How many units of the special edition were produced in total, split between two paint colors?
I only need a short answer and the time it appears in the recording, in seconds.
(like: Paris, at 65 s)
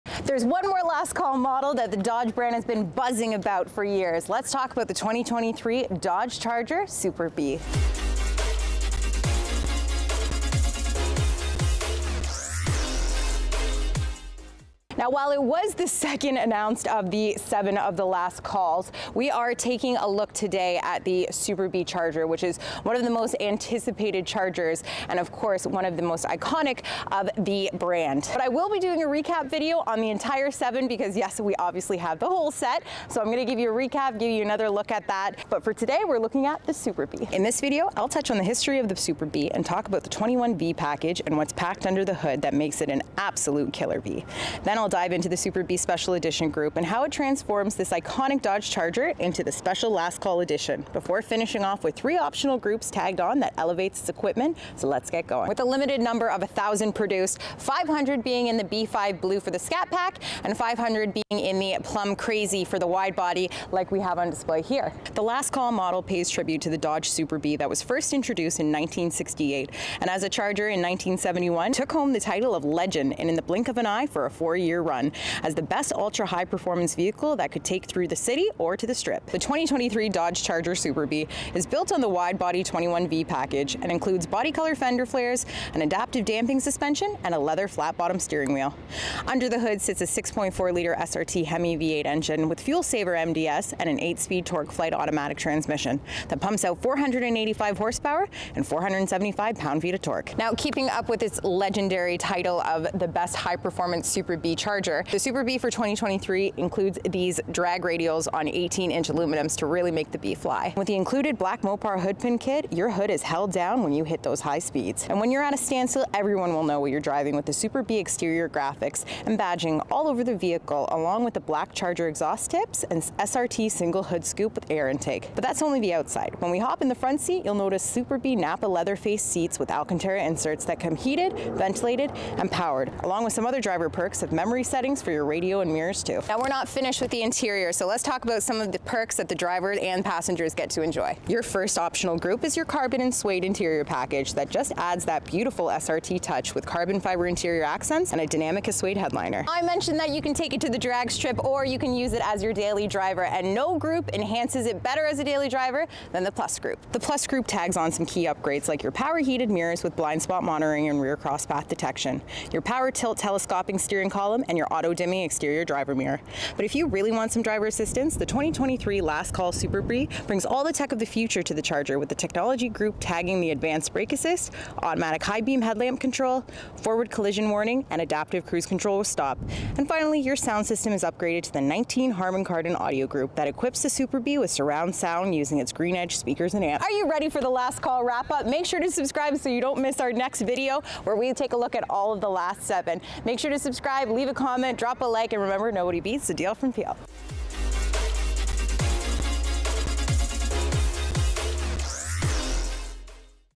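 1,000, at 56 s.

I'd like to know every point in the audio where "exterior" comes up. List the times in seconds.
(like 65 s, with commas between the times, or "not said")
117 s, 165 s.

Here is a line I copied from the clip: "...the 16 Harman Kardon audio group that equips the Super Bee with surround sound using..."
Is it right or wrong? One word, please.
wrong.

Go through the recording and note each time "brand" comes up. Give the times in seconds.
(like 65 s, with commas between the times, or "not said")
2 s, 27 s.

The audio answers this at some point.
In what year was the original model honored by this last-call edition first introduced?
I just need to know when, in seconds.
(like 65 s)
68 s.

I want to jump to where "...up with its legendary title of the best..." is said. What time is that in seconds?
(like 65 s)
100 s.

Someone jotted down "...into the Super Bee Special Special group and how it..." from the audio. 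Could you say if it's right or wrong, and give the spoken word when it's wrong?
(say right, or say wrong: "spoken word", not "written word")
wrong: "Edition", not "Special".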